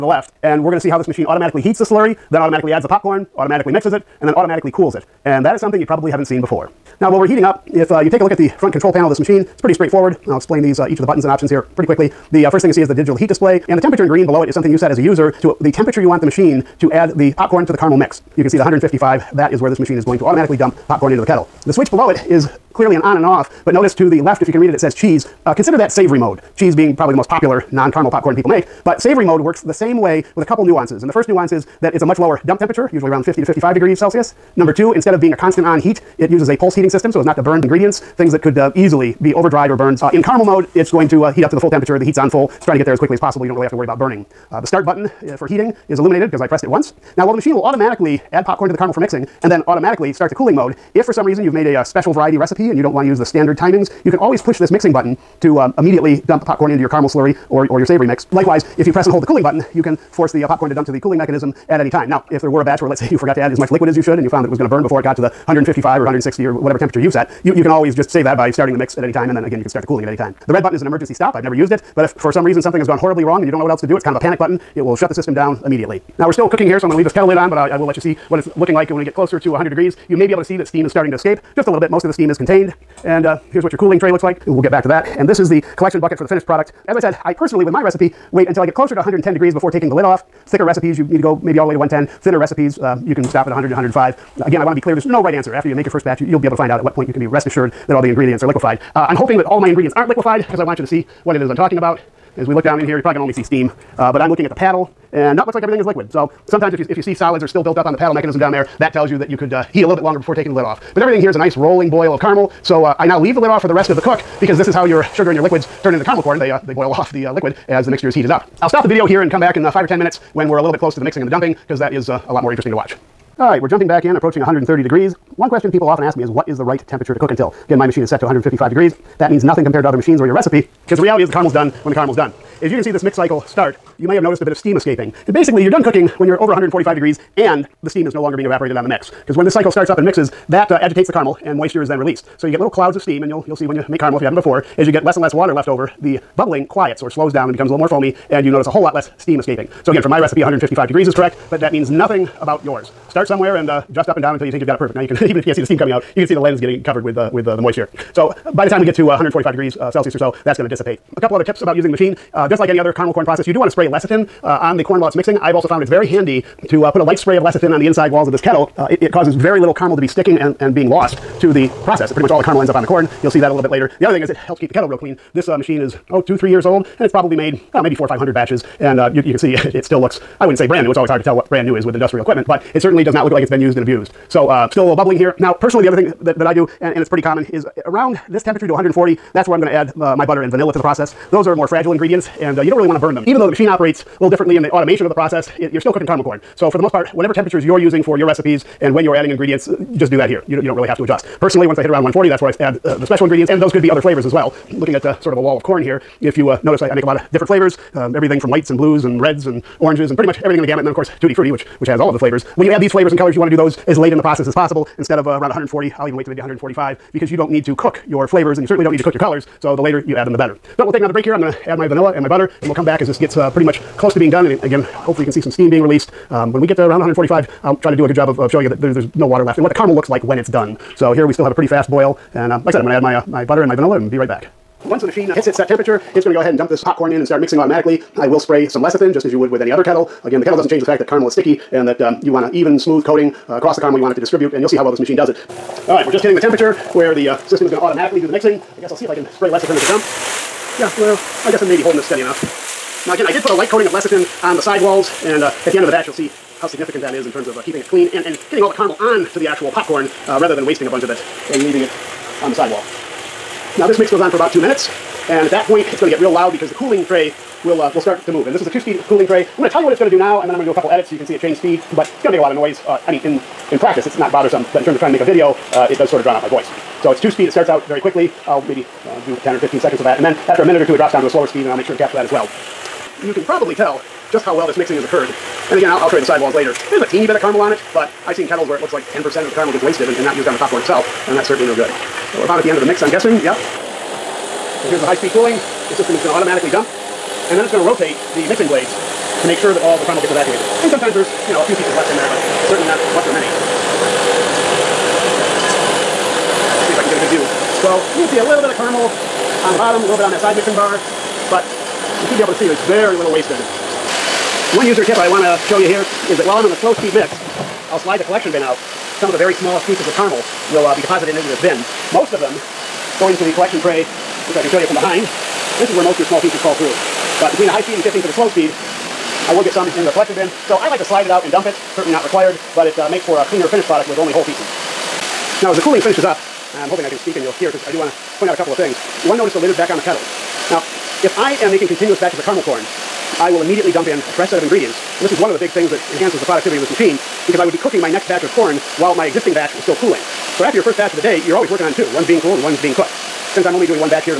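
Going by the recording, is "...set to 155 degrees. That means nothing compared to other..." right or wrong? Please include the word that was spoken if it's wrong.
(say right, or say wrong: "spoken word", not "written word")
right.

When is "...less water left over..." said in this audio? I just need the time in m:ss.
2:25.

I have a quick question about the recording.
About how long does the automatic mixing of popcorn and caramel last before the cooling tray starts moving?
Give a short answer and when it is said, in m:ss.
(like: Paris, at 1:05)
2 minutes, at 4:24.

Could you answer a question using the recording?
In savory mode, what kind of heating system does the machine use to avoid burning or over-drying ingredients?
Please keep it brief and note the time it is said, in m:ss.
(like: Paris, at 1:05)
pulse heating system, at 0:36.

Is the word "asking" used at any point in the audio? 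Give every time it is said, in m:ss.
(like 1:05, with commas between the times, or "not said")
not said.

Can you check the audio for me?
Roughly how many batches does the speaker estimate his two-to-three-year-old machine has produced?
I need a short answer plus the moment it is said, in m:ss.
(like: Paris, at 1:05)
400 or 500, at 2:57.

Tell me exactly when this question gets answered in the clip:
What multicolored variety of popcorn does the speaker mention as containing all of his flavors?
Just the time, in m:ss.
3:31.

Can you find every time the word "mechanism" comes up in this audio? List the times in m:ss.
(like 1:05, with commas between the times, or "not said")
1:01, 1:48.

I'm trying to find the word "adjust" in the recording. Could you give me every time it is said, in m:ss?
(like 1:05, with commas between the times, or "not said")
3:21.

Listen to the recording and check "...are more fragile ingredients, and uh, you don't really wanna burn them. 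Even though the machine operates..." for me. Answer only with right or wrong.
right.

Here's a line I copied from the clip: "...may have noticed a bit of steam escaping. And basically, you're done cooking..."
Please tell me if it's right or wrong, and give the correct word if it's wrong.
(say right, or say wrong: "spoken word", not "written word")
right.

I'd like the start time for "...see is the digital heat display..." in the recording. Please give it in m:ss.
0:12.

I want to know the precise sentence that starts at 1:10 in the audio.
The red button is an emergency stop.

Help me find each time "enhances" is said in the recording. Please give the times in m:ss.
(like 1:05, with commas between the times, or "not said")
5:46.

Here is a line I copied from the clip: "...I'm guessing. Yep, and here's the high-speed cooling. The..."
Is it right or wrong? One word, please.
right.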